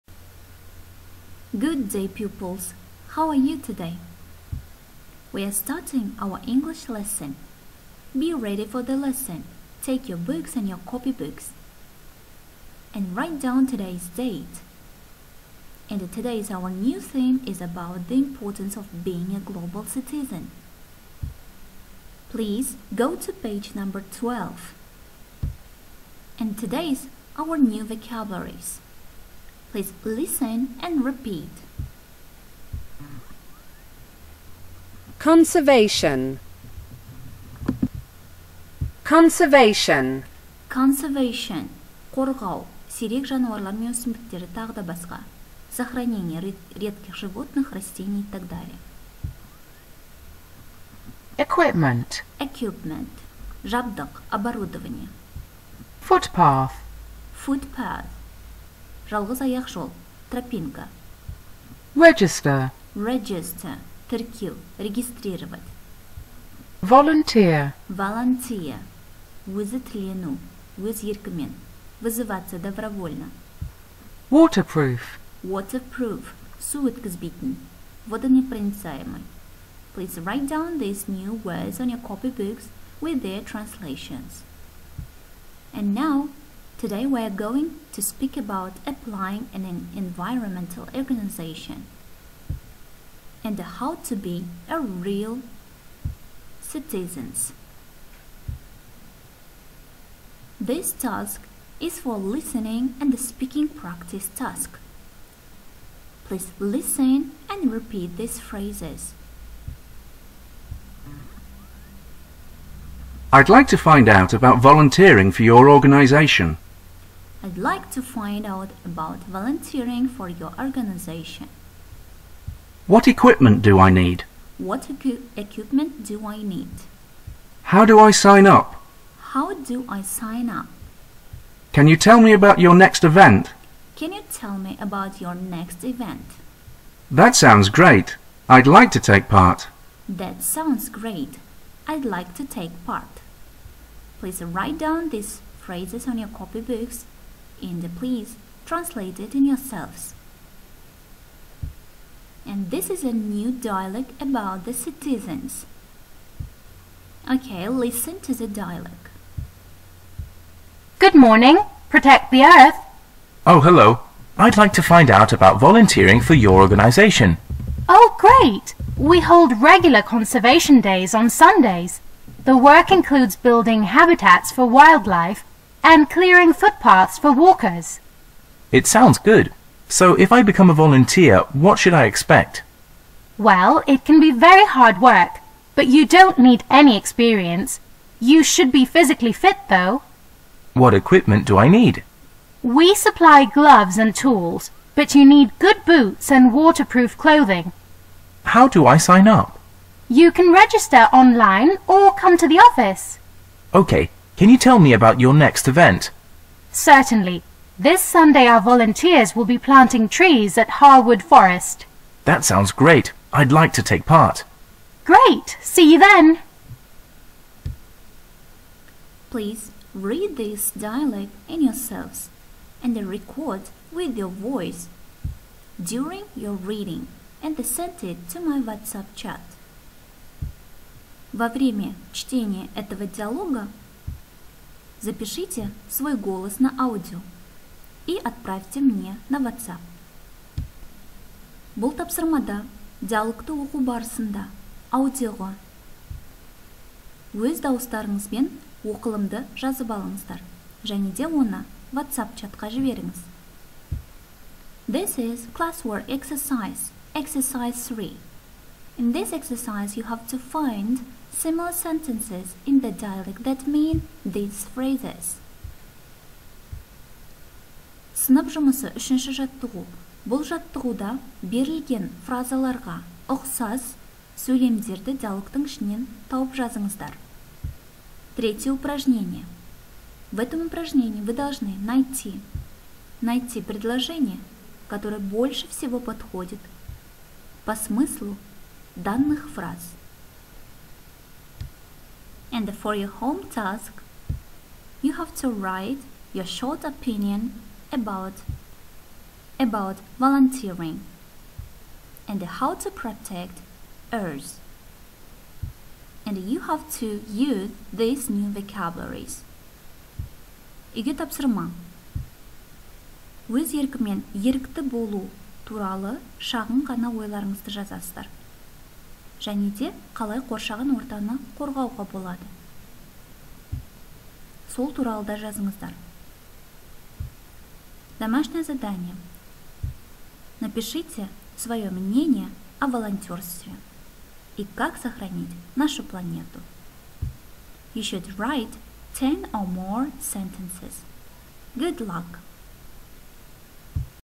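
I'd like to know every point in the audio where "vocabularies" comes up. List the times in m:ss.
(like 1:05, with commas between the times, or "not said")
0:27, 5:08.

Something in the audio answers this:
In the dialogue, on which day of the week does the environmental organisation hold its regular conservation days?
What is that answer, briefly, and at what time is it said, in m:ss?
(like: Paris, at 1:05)
Sundays, at 2:51.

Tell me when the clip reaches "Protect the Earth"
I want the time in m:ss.
2:41.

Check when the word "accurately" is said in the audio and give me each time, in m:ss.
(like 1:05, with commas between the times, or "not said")
not said.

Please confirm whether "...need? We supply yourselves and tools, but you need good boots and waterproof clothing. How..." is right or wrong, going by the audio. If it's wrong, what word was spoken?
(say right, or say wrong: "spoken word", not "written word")
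wrong: "gloves", not "yourselves".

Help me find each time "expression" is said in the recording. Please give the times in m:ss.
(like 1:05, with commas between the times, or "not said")
not said.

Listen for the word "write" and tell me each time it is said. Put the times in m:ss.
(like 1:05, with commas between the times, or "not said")
0:13, 1:20, 2:24, 4:55, 5:38.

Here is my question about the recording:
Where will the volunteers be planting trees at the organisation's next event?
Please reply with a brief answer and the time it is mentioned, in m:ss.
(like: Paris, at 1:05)
Harwood Forest, at 3:30.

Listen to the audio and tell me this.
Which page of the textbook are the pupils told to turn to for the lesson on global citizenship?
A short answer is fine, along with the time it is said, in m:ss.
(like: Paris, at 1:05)
12, at 0:23.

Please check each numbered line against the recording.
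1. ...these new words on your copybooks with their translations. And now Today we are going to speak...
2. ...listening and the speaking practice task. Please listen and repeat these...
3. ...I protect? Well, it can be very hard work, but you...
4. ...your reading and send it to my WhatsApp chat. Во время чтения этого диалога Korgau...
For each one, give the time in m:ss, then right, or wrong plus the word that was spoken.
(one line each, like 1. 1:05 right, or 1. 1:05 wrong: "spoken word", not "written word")
1. 1:20 right
2. 1:42 right
3. 3:01 wrong: "expect", not "protect"
4. 3:46 wrong: "Запишите", not "Korgau".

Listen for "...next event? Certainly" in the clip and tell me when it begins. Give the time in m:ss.
3:25.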